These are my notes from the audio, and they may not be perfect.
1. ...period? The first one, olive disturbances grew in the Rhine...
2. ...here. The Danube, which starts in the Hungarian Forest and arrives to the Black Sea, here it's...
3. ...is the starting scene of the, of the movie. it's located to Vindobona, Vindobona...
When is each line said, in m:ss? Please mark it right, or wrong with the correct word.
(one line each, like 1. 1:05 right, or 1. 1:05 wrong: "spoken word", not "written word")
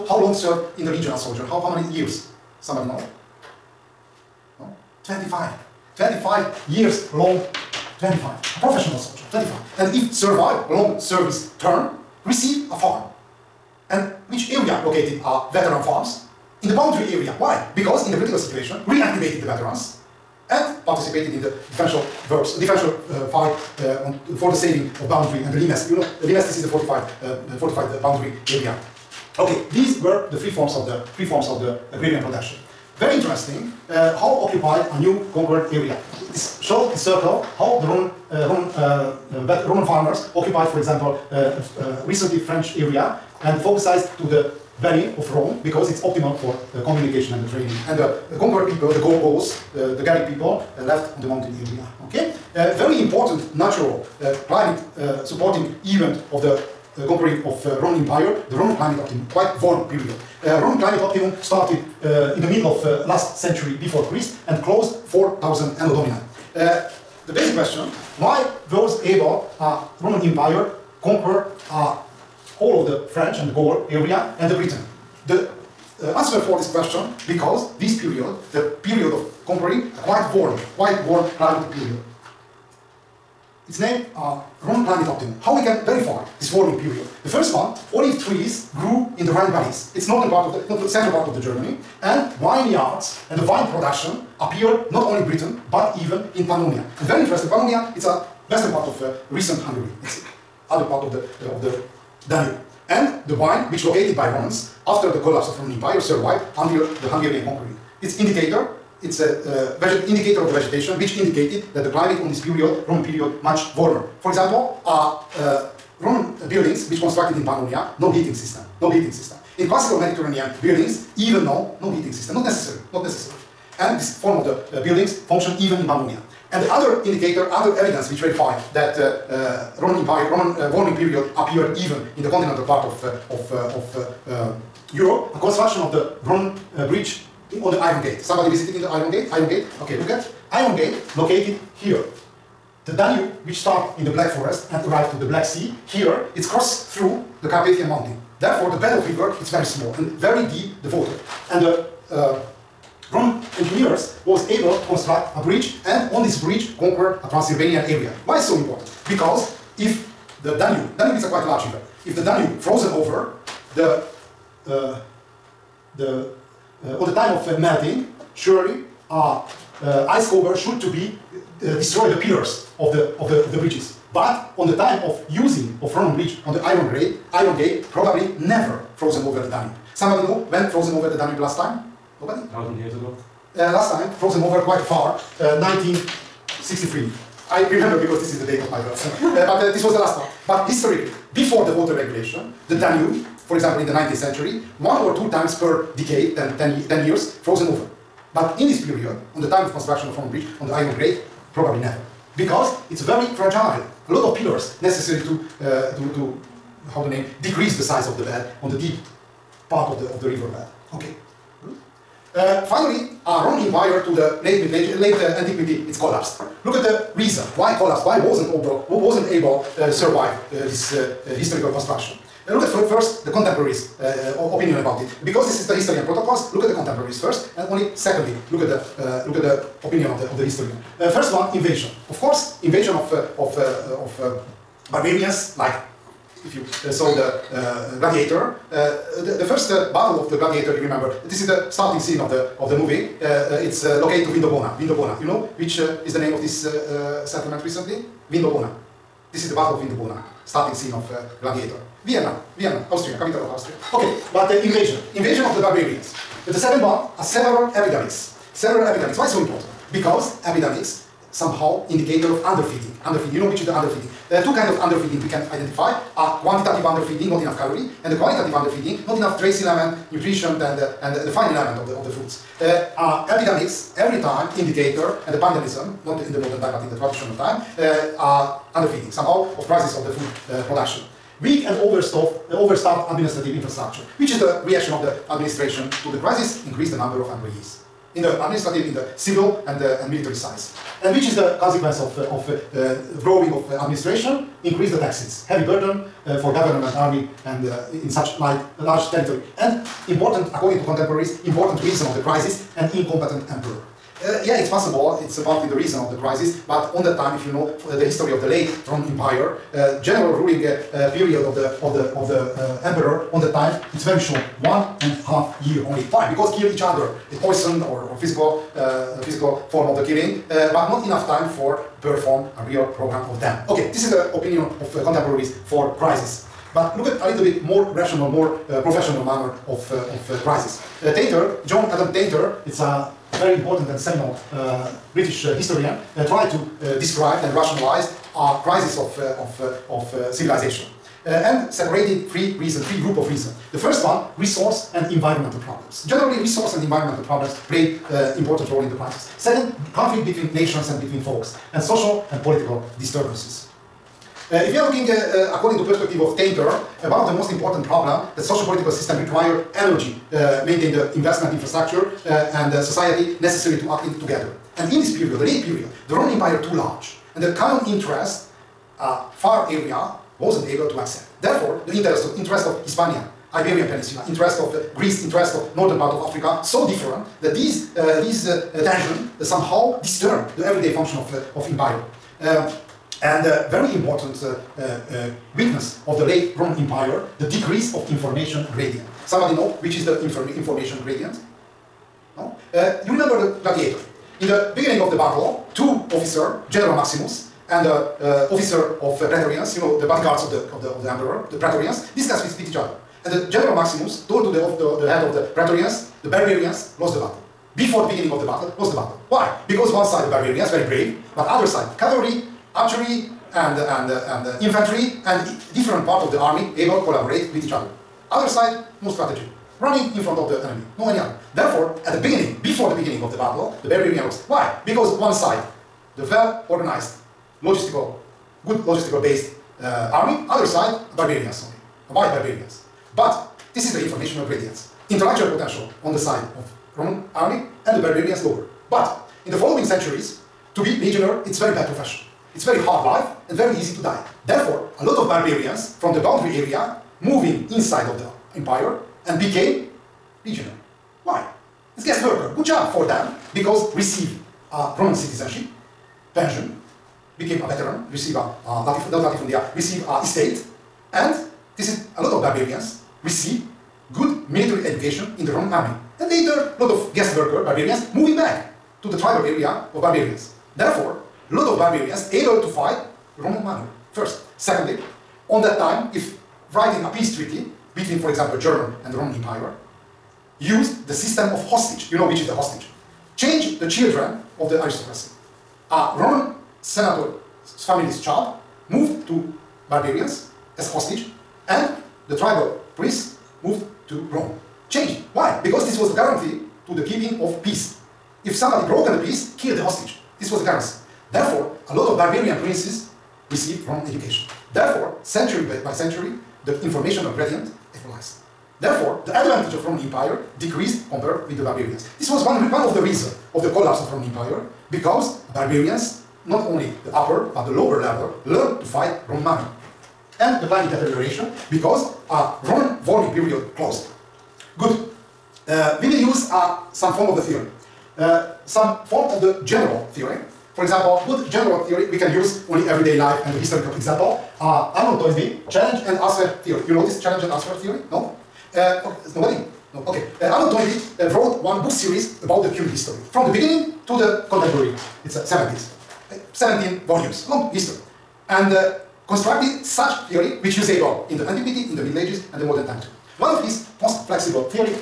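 1. 1:26 wrong: "trees", not "disturbances"
2. 2:21 wrong: "Black", not "Hungarian"
3. 4:01 right.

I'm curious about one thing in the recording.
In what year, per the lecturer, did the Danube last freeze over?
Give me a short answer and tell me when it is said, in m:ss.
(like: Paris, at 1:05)
1963, at 3:05.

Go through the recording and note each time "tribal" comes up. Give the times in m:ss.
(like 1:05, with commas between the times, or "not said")
7:49, 8:12.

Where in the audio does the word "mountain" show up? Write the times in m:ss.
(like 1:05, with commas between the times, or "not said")
0:51, 2:27.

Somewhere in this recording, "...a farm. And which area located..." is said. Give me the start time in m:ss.
0:12.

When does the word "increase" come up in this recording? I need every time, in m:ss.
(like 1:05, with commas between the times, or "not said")
4:46, 4:54.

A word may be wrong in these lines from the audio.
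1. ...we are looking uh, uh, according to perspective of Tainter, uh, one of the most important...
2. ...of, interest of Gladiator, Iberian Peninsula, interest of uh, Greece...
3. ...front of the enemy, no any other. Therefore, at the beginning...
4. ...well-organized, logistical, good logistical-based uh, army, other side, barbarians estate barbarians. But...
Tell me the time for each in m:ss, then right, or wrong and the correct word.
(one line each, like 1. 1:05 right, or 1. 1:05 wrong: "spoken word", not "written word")
1. 5:54 right
2. 6:12 wrong: "Hispania", not "Gladiator"
3. 7:00 right
4. 7:06 wrong: "white", not "estate".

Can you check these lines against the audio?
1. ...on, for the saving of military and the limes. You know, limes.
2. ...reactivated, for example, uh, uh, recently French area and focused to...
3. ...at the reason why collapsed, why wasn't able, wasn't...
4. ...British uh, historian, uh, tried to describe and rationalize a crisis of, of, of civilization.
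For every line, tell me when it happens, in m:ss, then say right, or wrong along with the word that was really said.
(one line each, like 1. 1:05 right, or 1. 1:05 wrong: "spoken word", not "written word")
1. 0:24 wrong: "boundary", not "military"
2. 0:40 wrong: "occupied", not "reactivated"
3. 3:36 right
4. 5:35 right.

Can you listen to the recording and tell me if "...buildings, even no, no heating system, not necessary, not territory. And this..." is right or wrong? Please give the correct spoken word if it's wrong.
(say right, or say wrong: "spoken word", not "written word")
wrong: "necessary", not "territory".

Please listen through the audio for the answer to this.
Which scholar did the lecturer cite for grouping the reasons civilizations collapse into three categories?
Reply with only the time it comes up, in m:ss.
5:31.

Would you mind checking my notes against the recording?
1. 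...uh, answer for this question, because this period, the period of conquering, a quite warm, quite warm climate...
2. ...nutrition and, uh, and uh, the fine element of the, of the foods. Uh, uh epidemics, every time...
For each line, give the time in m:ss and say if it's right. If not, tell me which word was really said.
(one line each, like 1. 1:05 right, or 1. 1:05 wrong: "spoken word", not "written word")
1. 1:16 right
2. 4:30 right.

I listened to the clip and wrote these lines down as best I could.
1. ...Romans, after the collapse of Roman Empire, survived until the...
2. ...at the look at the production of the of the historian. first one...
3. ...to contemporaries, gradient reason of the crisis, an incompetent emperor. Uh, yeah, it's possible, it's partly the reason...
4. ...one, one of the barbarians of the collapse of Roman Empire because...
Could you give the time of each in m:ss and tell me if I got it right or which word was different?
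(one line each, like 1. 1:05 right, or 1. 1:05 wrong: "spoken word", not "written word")
1. 1:44 right
2. 3:48 wrong: "opinion", not "production"
3. 5:00 wrong: "important", not "gradient"
4. 8:32 wrong: "reasons", not "barbarians".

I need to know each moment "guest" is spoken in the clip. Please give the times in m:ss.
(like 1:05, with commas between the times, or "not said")
7:32, 7:47.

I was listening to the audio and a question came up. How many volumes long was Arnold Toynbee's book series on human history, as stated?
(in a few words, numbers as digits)
17.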